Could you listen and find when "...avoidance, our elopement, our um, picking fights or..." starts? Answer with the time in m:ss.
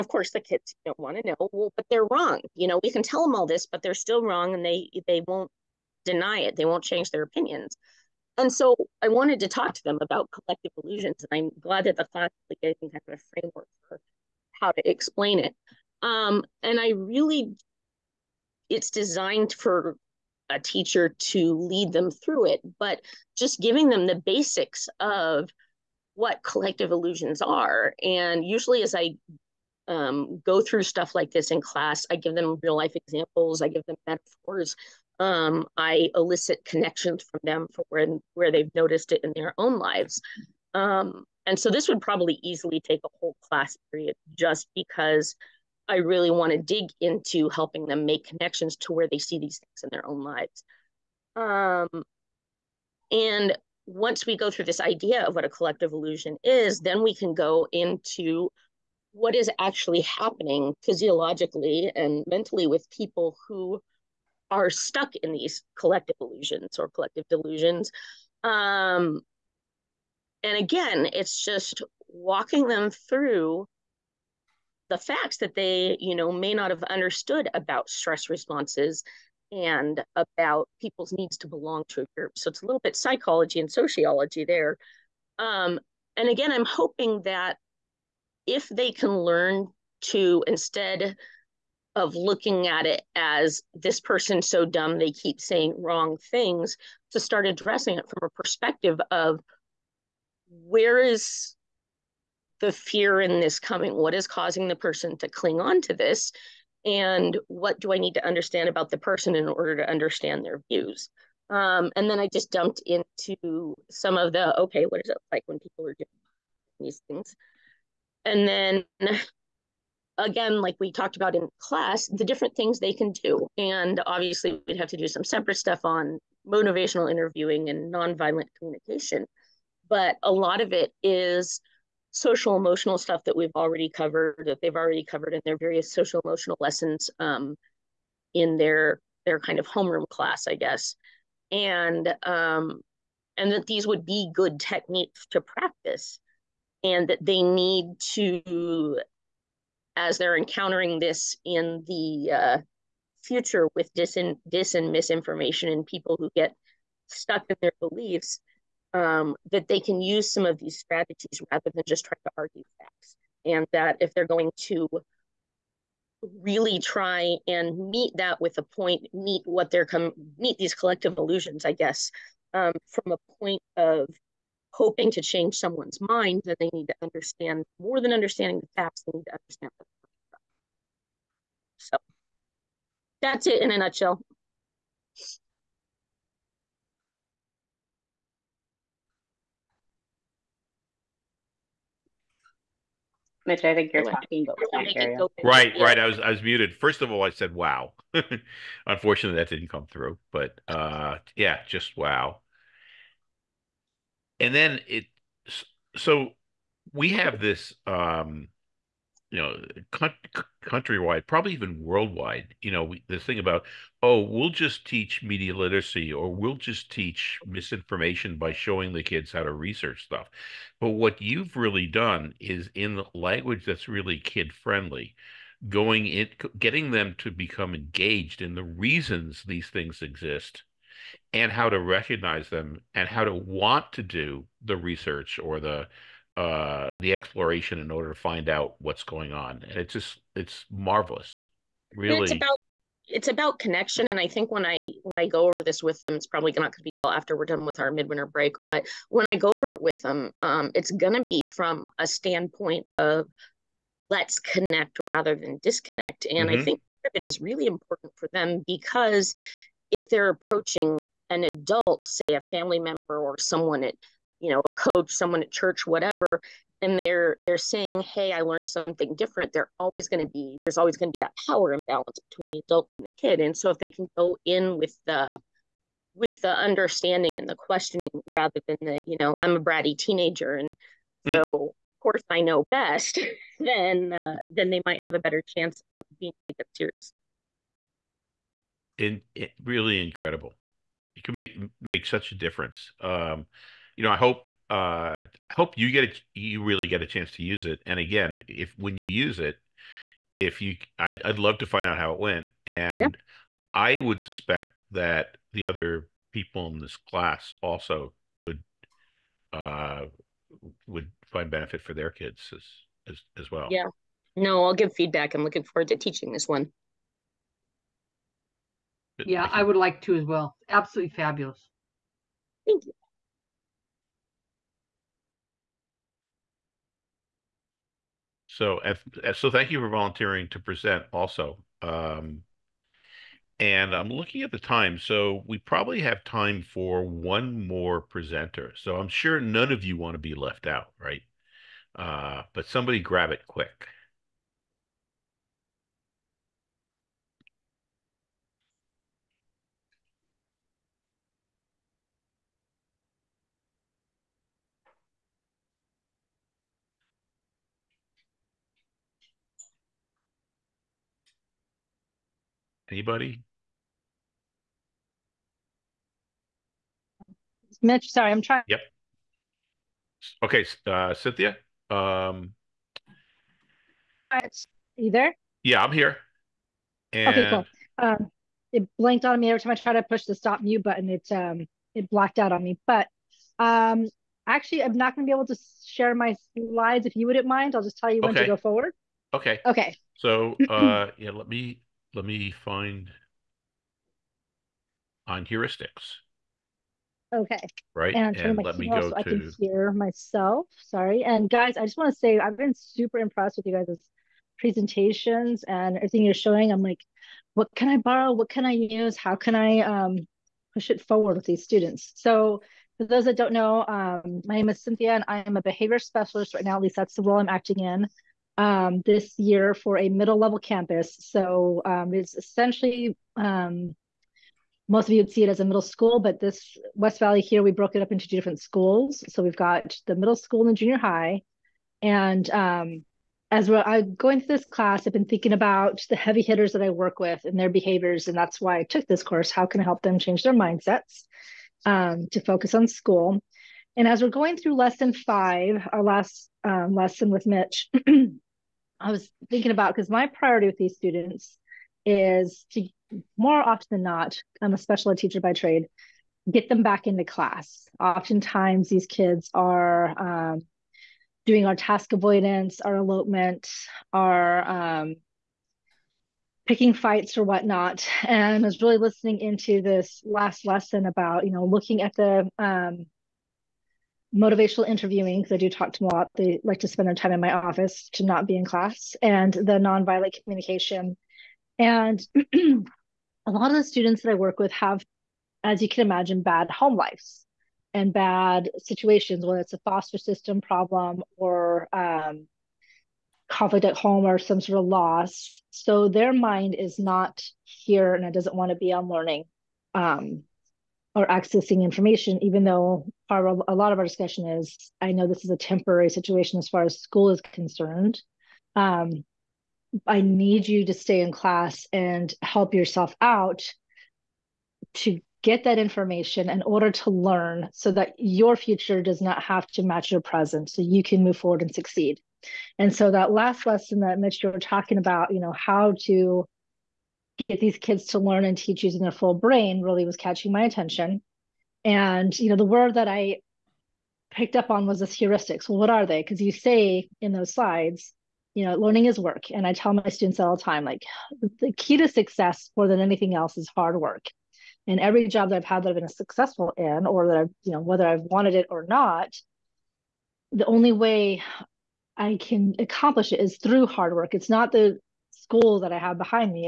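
7:42.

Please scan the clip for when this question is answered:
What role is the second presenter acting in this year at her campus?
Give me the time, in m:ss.
6:55.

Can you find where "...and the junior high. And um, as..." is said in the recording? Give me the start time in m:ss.
7:10.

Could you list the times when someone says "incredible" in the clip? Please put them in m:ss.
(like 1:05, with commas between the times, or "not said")
4:50.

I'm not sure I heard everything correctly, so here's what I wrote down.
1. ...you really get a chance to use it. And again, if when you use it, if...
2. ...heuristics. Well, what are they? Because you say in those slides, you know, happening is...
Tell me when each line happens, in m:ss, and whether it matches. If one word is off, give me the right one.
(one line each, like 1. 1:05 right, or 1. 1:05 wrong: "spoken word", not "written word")
1. 4:56 right
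2. 8:55 wrong: "learning", not "happening".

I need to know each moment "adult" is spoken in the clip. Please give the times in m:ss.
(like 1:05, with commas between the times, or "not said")
4:21, 4:32.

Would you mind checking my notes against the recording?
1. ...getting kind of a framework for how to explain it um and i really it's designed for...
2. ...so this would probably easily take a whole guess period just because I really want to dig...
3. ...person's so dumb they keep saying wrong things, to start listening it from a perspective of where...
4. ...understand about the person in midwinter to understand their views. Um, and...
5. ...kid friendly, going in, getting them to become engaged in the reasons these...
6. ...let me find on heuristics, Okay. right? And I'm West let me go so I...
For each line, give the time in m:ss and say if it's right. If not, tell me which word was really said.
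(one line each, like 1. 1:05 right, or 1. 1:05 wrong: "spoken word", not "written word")
1. 0:12 right
2. 0:41 wrong: "class", not "guess"
3. 1:33 wrong: "addressing", not "listening"
4. 1:48 wrong: "order", not "midwinter"
5. 3:44 right
6. 6:32 wrong: "And", not "West".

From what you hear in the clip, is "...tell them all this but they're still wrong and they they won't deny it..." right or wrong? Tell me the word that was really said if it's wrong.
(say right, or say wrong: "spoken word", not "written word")
right.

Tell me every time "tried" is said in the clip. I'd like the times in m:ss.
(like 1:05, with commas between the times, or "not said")
6:19.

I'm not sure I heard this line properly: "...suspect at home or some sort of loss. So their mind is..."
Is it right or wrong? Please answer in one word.
wrong.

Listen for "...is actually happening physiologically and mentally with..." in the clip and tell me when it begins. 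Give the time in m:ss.
0:59.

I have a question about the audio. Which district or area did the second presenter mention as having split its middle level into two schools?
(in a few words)
West Valley.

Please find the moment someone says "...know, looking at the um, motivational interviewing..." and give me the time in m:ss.
7:51.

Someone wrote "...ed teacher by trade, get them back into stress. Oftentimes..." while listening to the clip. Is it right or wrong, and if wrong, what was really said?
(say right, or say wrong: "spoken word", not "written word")
wrong: "class", not "stress".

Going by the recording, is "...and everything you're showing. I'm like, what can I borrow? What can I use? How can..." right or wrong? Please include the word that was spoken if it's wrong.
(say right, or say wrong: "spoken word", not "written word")
right.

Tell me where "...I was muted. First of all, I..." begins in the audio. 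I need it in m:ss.
3:16.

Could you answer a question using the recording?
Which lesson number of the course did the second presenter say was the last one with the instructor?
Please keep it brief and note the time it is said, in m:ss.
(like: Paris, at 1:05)
5, at 7:24.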